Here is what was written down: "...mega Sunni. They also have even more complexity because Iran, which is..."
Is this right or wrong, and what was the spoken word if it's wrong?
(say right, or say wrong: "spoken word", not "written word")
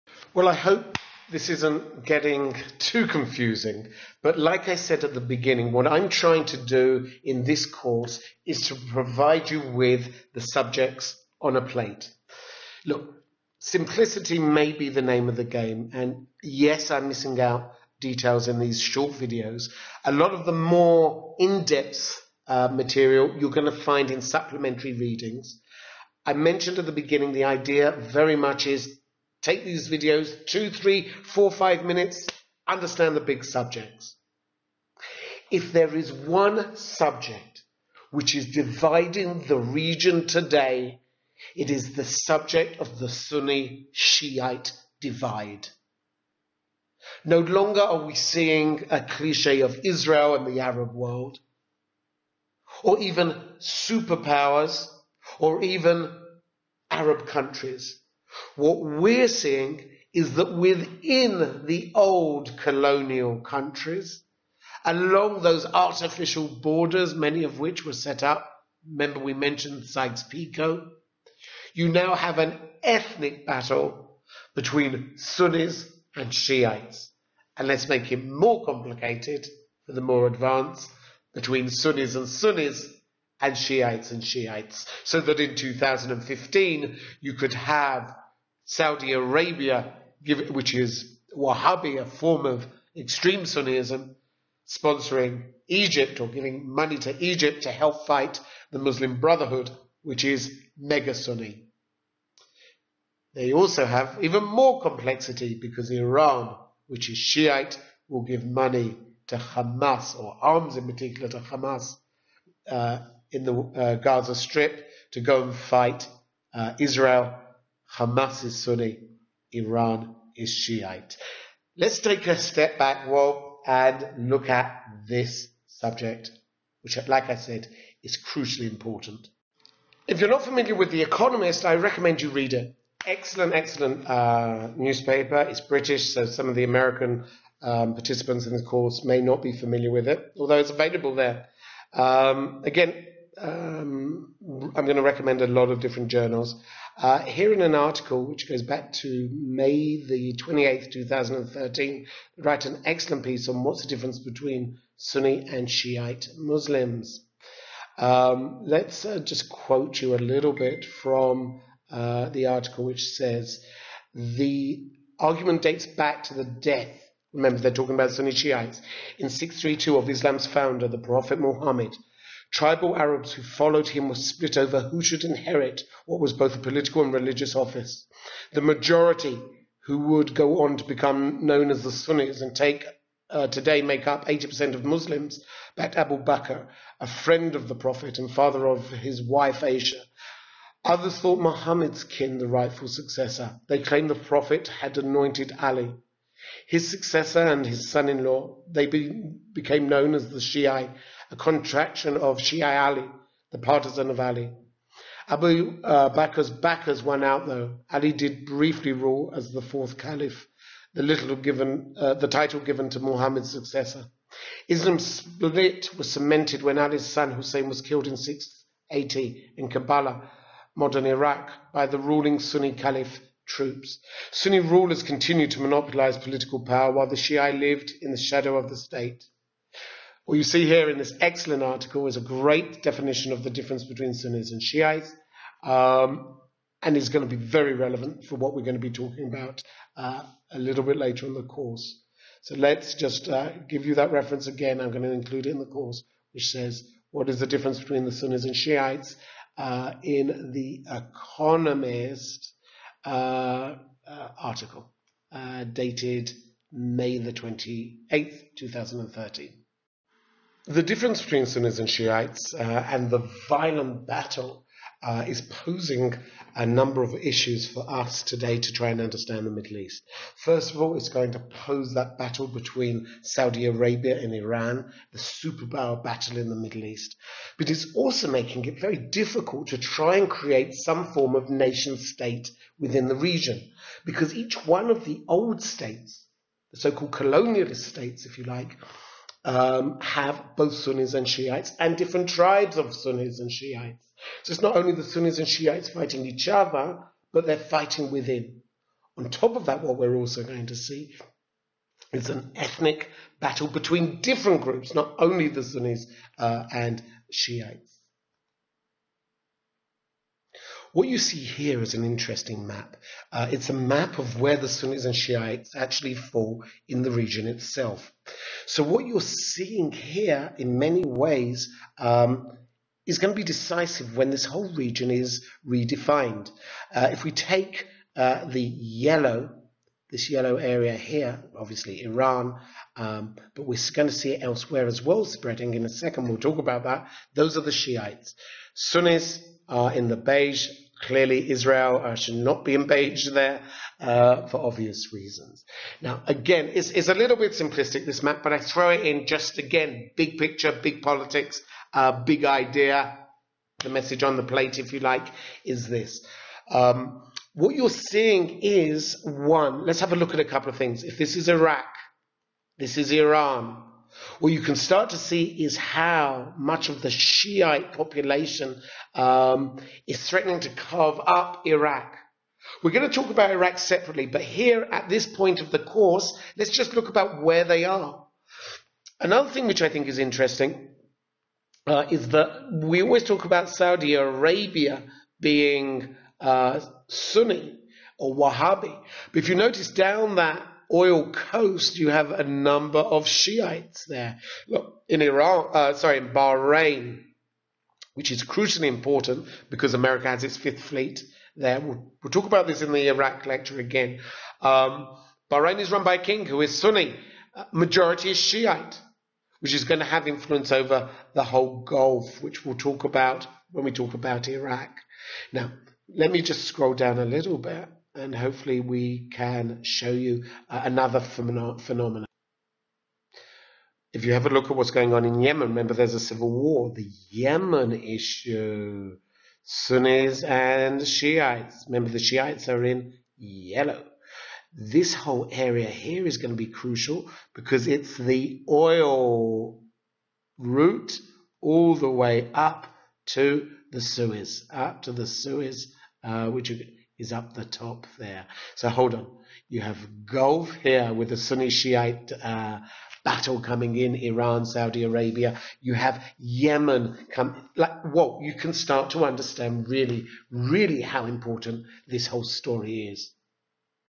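right.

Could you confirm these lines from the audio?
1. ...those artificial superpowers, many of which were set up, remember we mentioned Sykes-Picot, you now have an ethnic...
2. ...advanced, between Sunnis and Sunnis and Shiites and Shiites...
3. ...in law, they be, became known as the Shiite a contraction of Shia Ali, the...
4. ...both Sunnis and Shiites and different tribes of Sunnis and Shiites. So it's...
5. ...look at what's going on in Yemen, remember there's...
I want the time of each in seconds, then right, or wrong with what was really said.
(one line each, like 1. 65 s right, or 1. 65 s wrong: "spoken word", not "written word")
1. 65 s wrong: "borders", not "superpowers"
2. 80 s right
3. 198 s right
4. 290 s right
5. 424 s right.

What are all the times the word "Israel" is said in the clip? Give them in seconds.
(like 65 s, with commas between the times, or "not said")
49 s, 116 s, 341 s.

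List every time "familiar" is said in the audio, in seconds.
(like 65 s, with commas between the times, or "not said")
130 s, 139 s.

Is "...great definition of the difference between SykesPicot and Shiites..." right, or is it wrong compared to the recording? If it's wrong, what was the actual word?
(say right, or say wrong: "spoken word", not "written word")
wrong: "Sunnis", not "SykesPicot".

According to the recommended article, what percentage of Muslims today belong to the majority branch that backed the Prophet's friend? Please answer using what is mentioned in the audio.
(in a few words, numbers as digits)
80%.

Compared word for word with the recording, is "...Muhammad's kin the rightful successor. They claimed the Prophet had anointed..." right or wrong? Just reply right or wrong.
right.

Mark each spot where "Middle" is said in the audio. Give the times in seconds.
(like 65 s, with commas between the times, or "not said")
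269 s, 276 s.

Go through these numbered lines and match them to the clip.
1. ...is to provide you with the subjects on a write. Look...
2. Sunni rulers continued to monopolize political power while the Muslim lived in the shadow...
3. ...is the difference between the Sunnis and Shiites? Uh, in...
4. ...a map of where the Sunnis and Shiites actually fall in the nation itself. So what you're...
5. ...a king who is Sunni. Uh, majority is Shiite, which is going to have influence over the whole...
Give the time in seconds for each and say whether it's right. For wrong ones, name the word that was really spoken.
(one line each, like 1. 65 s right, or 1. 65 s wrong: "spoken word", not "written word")
1. 8 s wrong: "plate", not "write"
2. 224 s wrong: "Shia", not "Muslim"
3. 247 s right
4. 313 s wrong: "region", not "nation"
5. 406 s right.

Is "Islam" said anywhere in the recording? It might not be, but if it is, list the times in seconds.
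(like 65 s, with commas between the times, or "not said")
170 s, 214 s.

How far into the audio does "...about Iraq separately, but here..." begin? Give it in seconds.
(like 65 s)
373 s.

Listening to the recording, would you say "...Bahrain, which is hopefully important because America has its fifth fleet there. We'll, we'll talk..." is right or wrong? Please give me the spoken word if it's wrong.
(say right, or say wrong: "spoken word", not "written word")
wrong: "crucially", not "hopefully".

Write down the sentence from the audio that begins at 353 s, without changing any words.
The message on the plate, if you like, is this.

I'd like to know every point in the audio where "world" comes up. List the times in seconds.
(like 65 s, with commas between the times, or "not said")
50 s.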